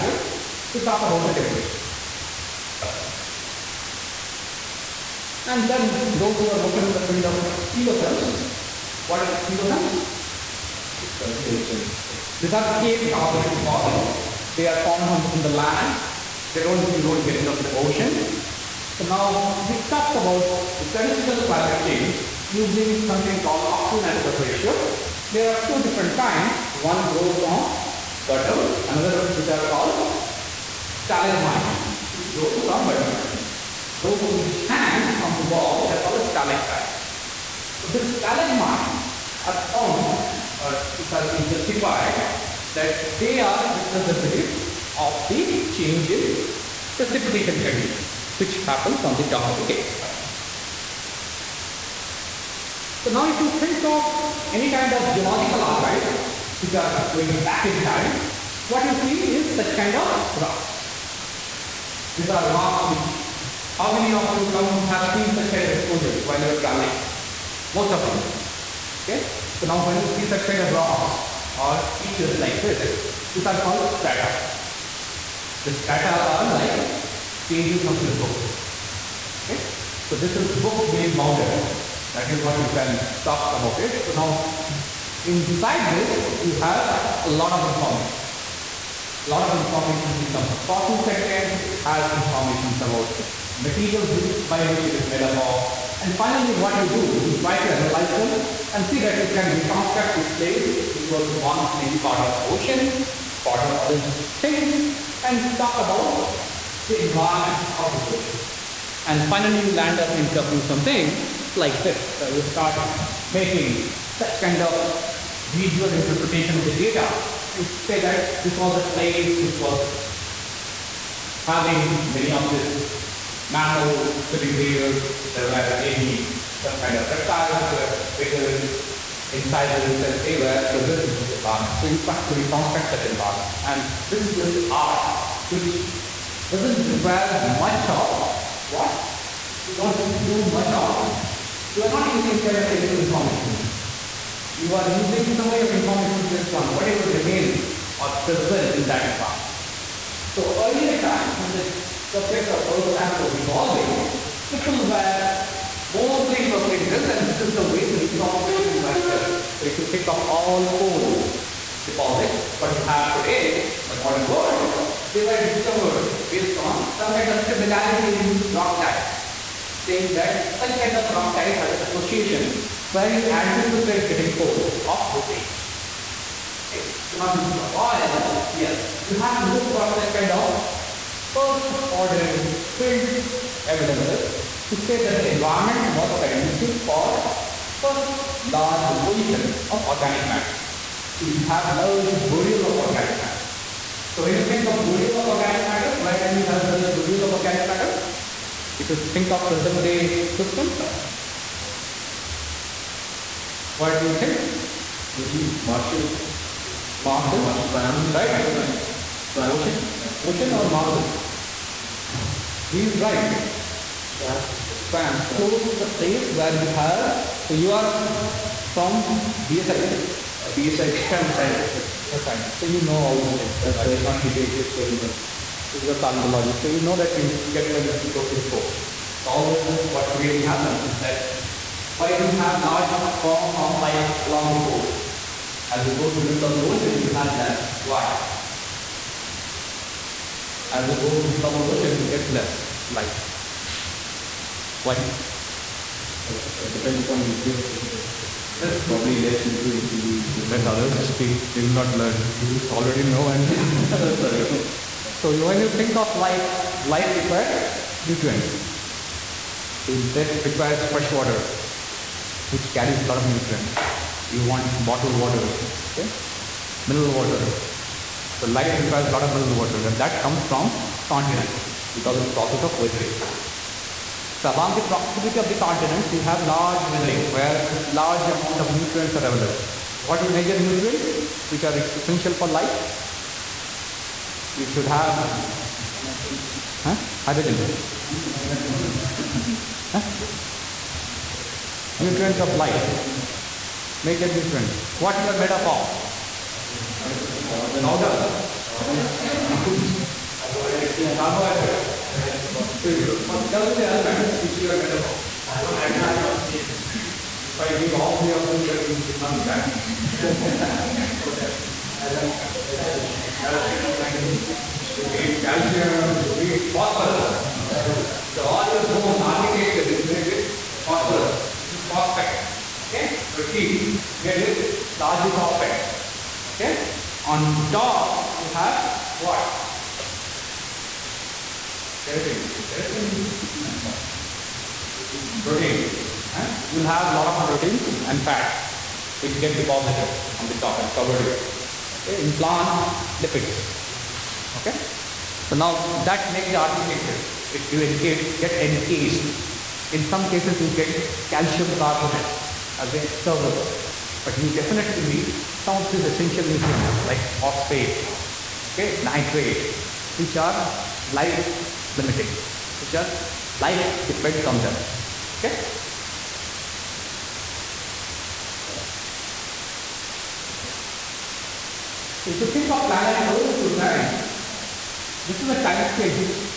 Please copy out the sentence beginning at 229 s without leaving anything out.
So all this, what really happens is that why do you have large form of life along the coast?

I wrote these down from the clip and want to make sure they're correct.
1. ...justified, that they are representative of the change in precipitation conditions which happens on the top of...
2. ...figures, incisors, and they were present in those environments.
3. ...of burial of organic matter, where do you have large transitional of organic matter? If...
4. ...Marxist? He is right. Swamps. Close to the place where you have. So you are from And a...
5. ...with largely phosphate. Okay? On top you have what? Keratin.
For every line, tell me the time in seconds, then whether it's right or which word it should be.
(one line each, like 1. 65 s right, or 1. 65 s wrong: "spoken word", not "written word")
1. 41 s right
2. 128 s right
3. 194 s wrong: "burial", not "transitional"
4. 210 s wrong: "BSI", not "And"
5. 324 s right.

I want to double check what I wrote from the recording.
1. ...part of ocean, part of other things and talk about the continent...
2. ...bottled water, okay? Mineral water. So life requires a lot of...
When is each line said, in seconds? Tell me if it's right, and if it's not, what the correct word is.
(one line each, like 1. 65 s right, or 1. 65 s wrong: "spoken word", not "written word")
1. 101 s wrong: "environment", not "continent"
2. 264 s right.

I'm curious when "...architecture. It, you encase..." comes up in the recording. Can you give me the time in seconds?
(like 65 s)
346 s.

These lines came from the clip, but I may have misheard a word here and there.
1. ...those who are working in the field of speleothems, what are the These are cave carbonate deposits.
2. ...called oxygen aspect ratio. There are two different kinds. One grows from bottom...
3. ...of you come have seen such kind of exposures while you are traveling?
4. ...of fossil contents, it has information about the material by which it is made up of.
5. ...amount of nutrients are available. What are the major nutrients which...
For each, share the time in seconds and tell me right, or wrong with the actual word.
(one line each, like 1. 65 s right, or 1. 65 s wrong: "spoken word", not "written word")
1. 6 s right
2. 23 s right
3. 64 s right
4. 90 s right
5. 278 s right.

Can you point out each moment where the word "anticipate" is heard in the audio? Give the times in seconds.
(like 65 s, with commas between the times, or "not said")
173 s.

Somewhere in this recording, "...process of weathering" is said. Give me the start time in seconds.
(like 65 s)
272 s.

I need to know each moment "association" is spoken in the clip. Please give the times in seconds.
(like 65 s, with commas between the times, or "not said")
171 s.